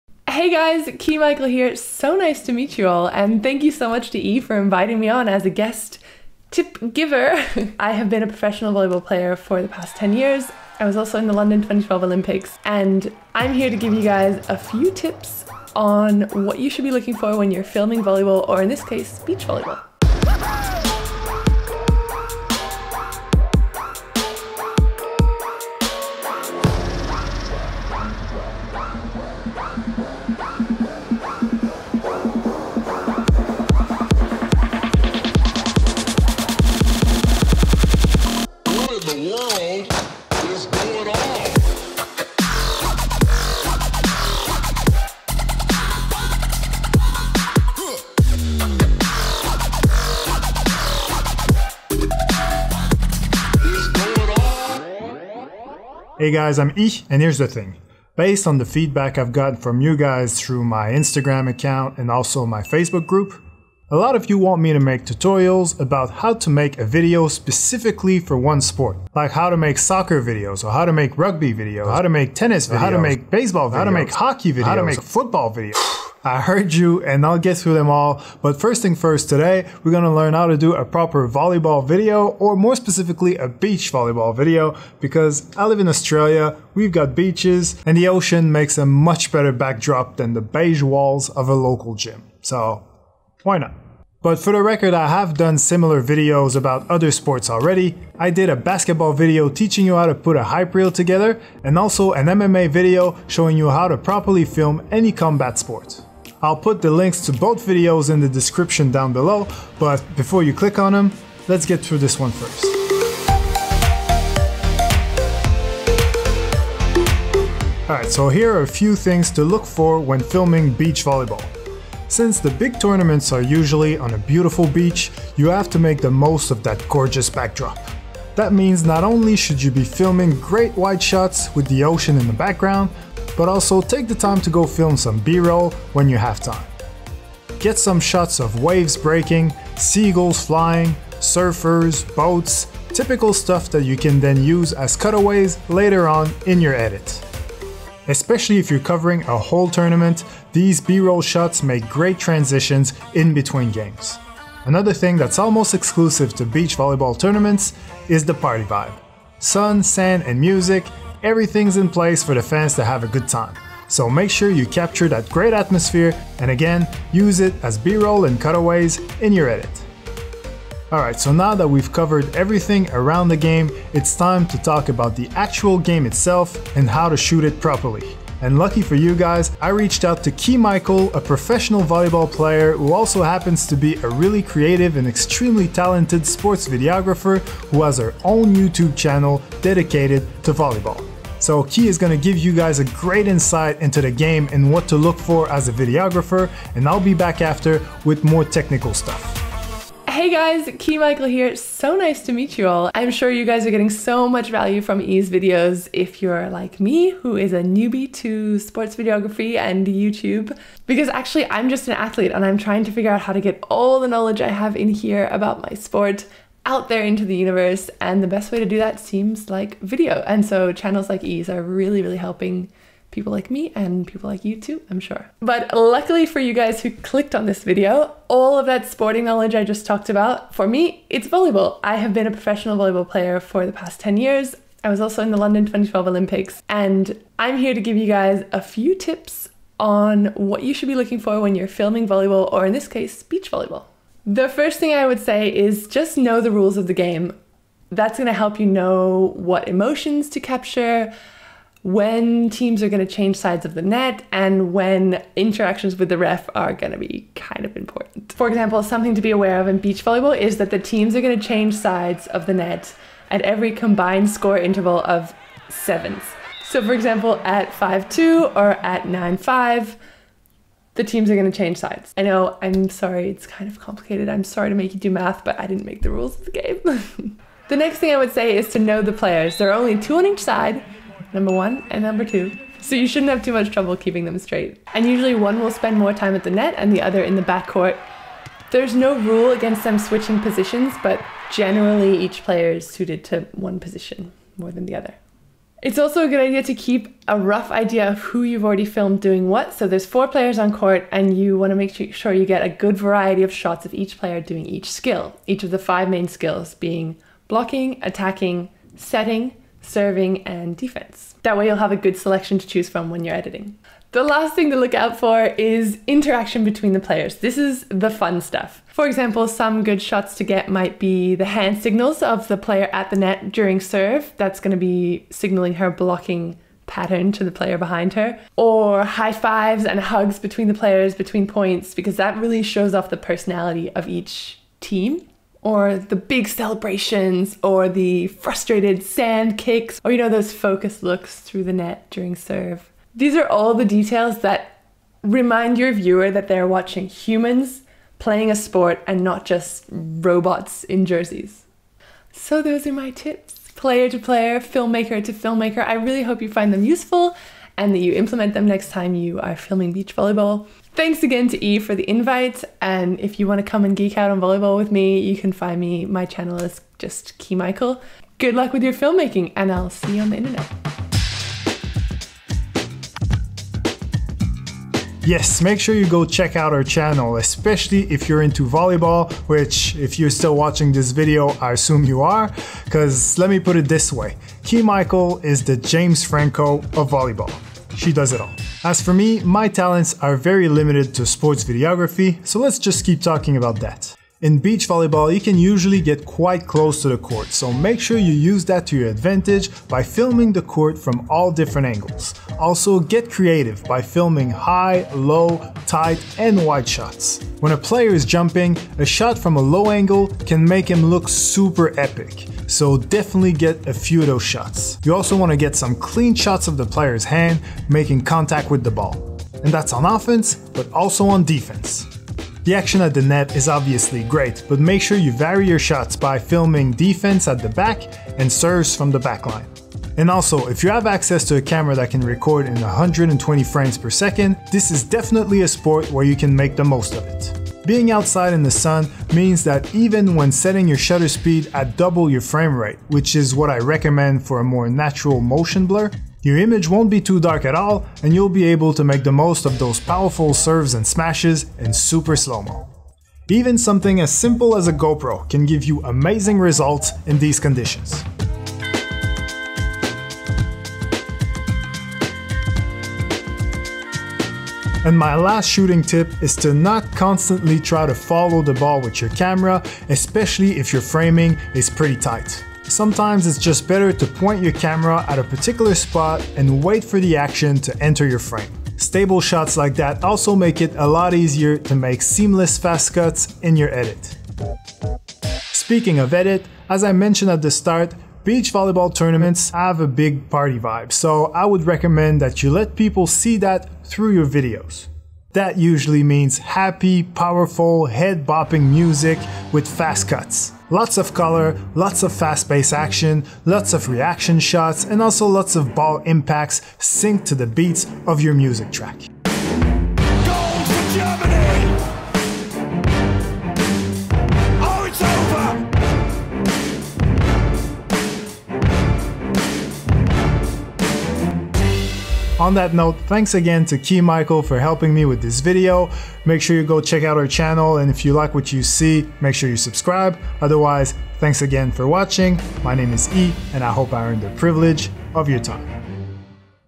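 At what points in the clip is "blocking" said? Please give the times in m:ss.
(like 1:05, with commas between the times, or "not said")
5:07, 5:25.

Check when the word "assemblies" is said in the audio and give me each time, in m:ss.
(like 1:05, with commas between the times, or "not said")
not said.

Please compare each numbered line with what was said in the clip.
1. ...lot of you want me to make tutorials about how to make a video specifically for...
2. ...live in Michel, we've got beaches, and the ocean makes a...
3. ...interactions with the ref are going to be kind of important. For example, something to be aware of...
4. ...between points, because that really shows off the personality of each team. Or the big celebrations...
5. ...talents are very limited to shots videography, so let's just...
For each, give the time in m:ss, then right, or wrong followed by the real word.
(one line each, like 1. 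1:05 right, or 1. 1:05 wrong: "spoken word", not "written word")
1. 1:03 right
2. 1:25 wrong: "Australia", not "Michel"
3. 4:15 right
4. 5:31 right
5. 6:29 wrong: "sports", not "shots".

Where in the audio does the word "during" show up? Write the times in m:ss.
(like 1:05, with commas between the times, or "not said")
5:23, 5:42.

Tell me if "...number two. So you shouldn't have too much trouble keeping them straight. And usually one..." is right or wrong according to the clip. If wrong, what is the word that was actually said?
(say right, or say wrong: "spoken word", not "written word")
right.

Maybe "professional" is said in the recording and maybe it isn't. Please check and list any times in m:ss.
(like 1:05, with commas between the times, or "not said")
0:08, 3:01, 3:52.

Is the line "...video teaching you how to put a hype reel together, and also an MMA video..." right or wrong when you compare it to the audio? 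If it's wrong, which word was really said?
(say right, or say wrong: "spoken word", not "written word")
right.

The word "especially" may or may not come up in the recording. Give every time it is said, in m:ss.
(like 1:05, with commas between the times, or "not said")
2:28, 6:17, 7:50.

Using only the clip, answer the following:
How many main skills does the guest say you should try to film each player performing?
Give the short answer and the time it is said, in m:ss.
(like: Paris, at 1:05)
5, at 5:05.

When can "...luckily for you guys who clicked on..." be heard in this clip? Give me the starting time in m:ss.
3:45.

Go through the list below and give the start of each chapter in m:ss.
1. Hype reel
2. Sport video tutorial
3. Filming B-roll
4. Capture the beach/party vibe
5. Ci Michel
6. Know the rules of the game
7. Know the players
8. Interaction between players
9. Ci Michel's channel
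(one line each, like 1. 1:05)
1. 0:19
2. 0:56
3. 1:54
4. 2:35
5. 2:58
6. 4:04
7. 4:37
8. 5:14
9. 6:02.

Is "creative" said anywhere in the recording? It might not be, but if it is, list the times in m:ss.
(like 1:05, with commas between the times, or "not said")
3:04, 6:43.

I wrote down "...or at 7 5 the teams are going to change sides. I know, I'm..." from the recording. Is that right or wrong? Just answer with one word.
wrong.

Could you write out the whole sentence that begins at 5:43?
These are all the details that remind your viewer that they're watching humans playing a sport and not just robots in jerseys.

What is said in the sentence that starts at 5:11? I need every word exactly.
That way, you'll have a good selection to choose from when you're editing.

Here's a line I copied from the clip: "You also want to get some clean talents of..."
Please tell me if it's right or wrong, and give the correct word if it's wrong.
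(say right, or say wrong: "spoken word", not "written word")
wrong: "shots", not "talents".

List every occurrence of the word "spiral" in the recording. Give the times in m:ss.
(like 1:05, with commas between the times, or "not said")
not said.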